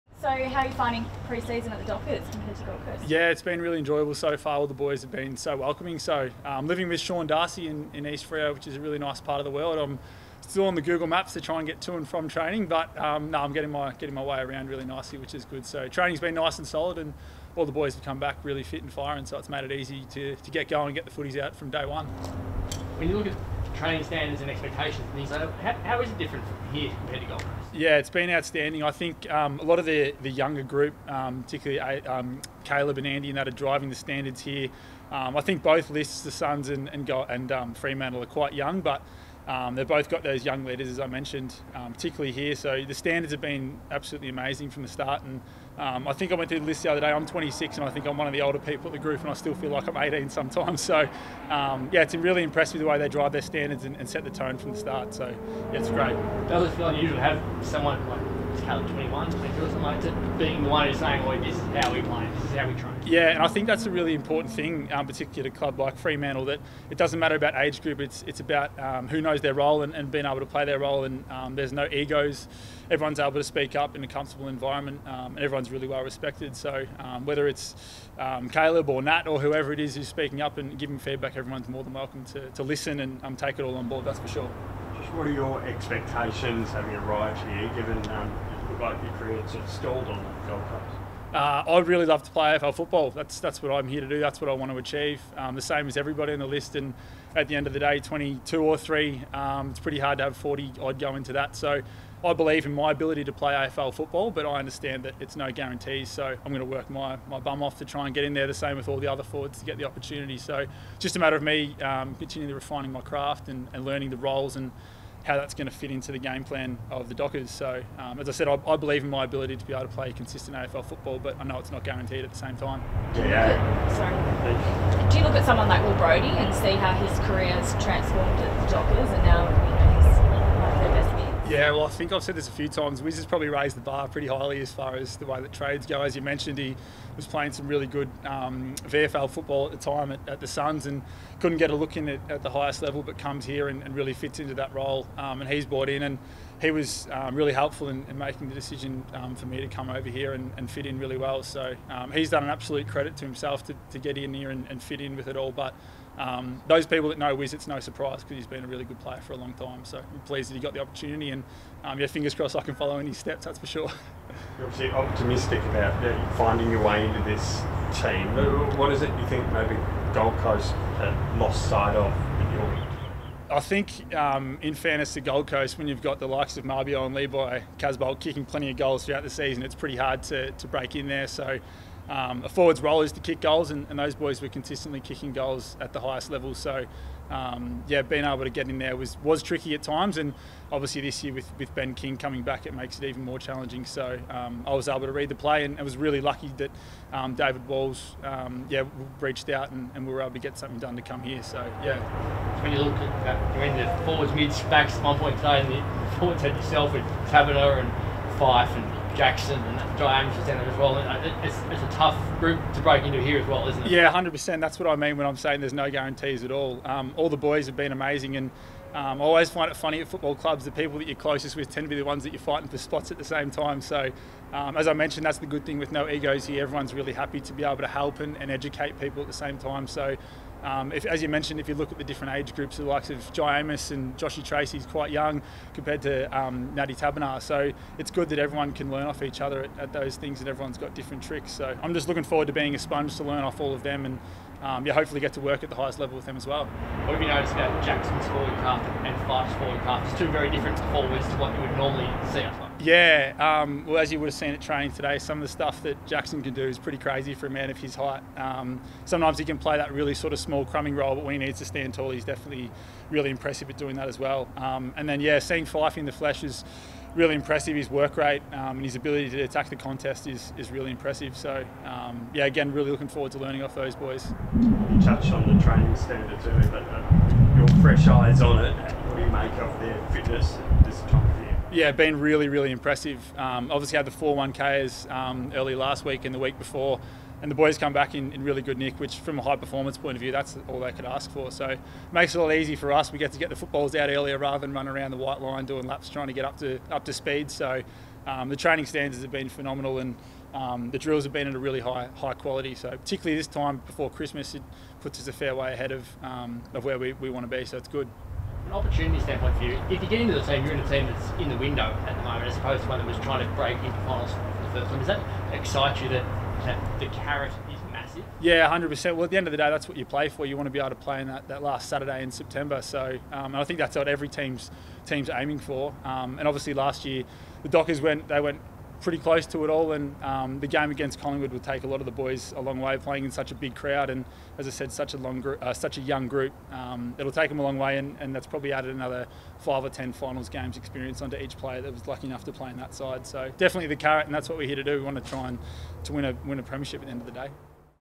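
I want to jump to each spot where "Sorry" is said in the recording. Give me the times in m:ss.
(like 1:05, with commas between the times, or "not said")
2:03.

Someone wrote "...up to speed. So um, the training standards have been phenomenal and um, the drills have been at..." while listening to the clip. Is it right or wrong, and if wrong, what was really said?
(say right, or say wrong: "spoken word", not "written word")
right.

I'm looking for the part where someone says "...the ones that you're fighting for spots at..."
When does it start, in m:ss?
3:41.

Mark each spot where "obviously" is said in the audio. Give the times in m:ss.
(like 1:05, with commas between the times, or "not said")
2:44, 3:10, 4:43, 5:26.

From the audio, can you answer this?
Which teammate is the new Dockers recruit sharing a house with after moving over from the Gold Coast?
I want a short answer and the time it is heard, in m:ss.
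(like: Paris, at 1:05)
Sean Darcy, at 0:06.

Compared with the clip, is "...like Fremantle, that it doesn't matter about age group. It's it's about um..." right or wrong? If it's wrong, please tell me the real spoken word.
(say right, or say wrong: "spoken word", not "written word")
right.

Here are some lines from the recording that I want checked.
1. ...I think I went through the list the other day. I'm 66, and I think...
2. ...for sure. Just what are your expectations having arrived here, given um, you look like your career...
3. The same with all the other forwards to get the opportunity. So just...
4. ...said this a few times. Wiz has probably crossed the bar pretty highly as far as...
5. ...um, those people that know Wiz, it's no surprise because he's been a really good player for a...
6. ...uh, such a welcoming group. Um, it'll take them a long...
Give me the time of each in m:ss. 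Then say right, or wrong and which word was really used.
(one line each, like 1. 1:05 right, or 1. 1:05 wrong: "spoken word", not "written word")
1. 0:46 wrong: "26", not "66"
2. 1:24 right
3. 1:48 right
4. 2:12 wrong: "raised", not "crossed"
5. 2:36 right
6. 5:35 wrong: "young", not "welcoming".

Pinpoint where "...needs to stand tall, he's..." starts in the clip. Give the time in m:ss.
4:21.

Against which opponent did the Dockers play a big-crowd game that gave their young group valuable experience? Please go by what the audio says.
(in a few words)
Collingwood.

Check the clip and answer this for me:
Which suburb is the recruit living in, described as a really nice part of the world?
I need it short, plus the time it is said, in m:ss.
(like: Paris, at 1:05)
East Freo, at 0:08.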